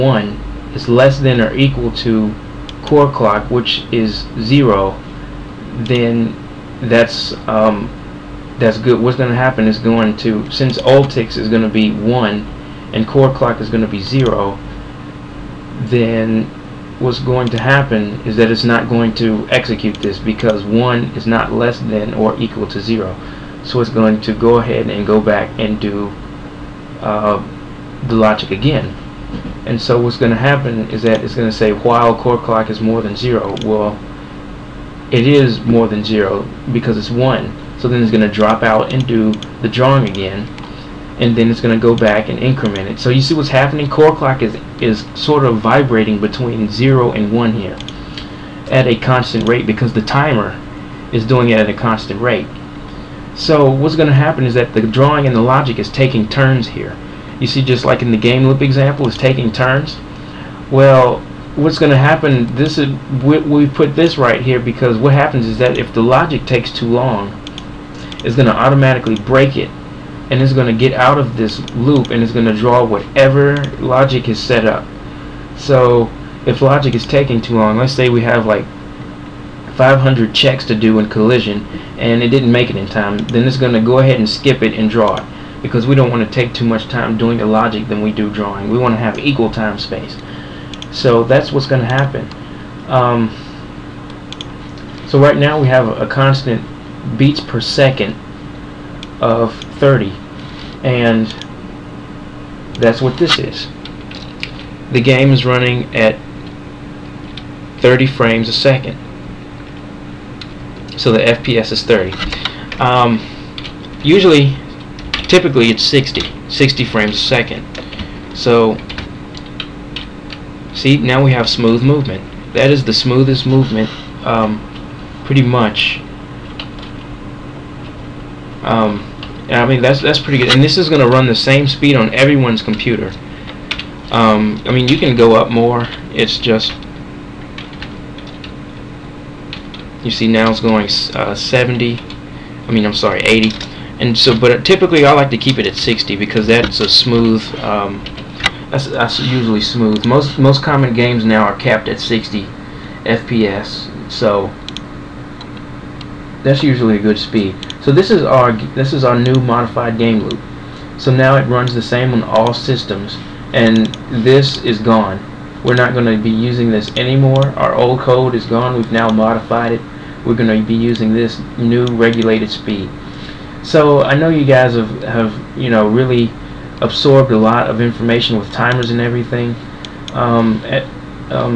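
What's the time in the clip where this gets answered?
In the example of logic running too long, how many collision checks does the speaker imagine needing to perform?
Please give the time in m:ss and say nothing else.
1:19.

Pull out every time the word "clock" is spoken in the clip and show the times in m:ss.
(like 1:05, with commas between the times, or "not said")
0:03, 0:13, 0:32, 0:44.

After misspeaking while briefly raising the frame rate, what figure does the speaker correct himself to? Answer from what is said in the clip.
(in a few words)
80.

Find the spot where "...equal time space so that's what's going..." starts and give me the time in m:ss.
1:29.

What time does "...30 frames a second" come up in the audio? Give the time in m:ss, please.
1:47.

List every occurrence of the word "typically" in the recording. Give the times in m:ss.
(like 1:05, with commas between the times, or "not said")
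1:55, 2:24.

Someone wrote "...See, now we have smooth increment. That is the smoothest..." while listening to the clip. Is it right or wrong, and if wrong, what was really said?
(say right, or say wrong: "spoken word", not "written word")
wrong: "movement", not "increment".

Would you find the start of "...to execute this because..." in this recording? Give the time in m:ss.
0:19.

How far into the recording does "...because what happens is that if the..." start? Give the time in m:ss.
1:04.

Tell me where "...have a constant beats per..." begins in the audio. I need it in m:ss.
1:35.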